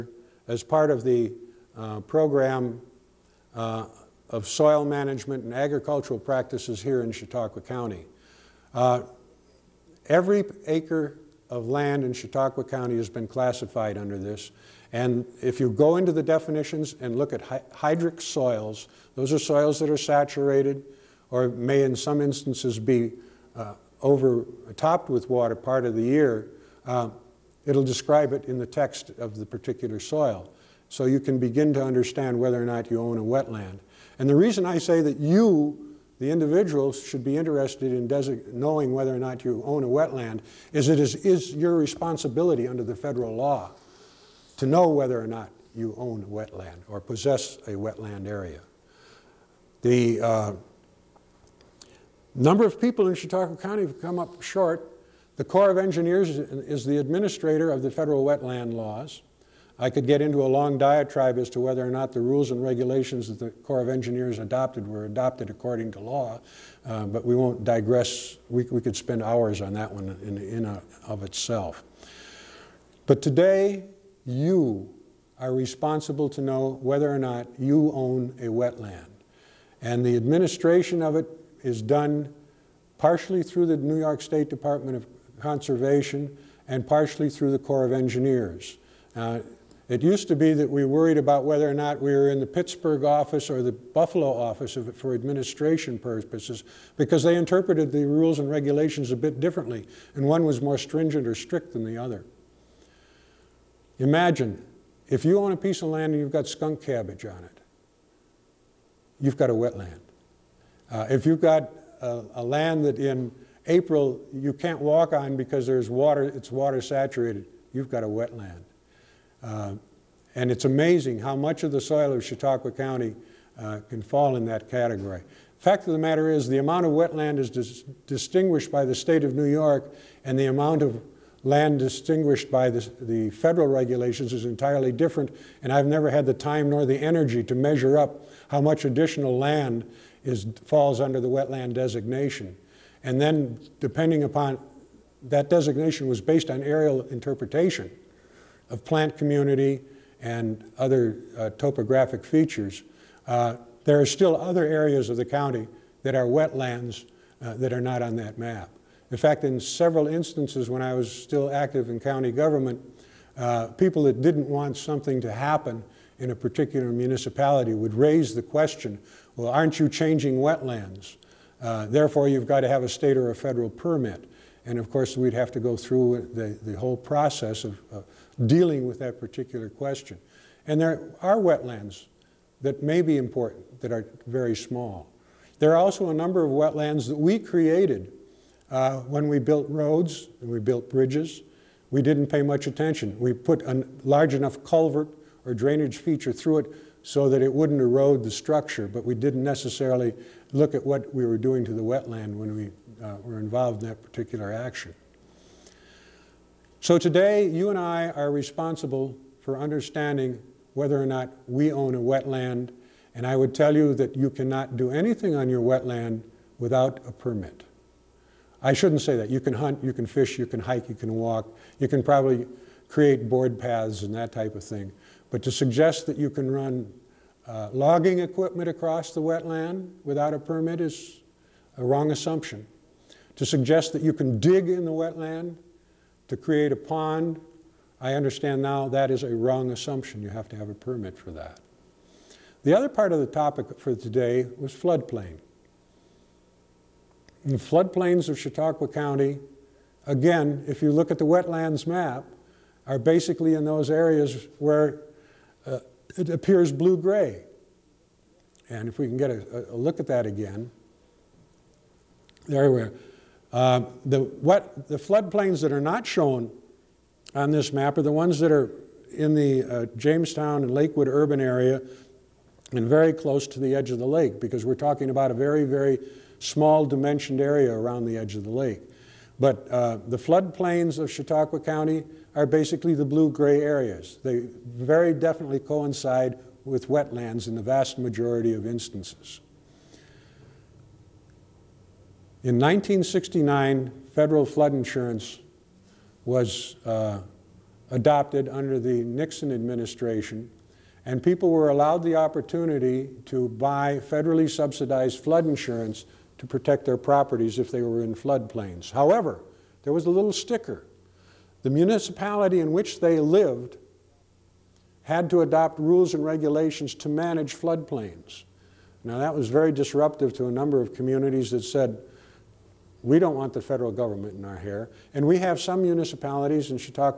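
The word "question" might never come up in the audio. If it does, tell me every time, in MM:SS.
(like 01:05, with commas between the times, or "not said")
02:48, 02:59.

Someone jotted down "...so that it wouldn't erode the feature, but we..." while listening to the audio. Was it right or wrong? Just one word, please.
wrong.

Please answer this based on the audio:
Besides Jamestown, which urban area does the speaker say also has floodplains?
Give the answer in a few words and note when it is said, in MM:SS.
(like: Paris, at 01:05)
Lakewood, at 04:30.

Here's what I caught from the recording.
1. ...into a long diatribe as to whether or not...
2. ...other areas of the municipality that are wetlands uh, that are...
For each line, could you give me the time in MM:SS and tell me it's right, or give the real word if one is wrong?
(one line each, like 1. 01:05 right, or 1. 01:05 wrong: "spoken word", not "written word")
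1. 01:00 right
2. 02:34 wrong: "county", not "municipality".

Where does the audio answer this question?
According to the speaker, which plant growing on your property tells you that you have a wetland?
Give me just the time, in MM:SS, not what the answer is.
01:46.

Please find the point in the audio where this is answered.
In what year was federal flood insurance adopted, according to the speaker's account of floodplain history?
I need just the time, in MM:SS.
04:52.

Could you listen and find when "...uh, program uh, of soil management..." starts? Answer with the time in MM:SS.
00:01.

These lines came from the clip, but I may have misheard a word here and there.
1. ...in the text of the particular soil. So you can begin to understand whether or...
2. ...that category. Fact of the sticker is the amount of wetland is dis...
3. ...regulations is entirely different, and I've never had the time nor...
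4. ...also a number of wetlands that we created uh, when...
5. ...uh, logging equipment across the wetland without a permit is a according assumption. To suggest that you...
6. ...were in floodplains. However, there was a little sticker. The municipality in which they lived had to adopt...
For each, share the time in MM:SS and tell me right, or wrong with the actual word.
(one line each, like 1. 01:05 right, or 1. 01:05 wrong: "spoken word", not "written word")
1. 00:28 right
2. 02:04 wrong: "matter", not "sticker"
3. 02:13 right
4. 03:05 right
5. 03:47 wrong: "wrong", not "according"
6. 05:07 right.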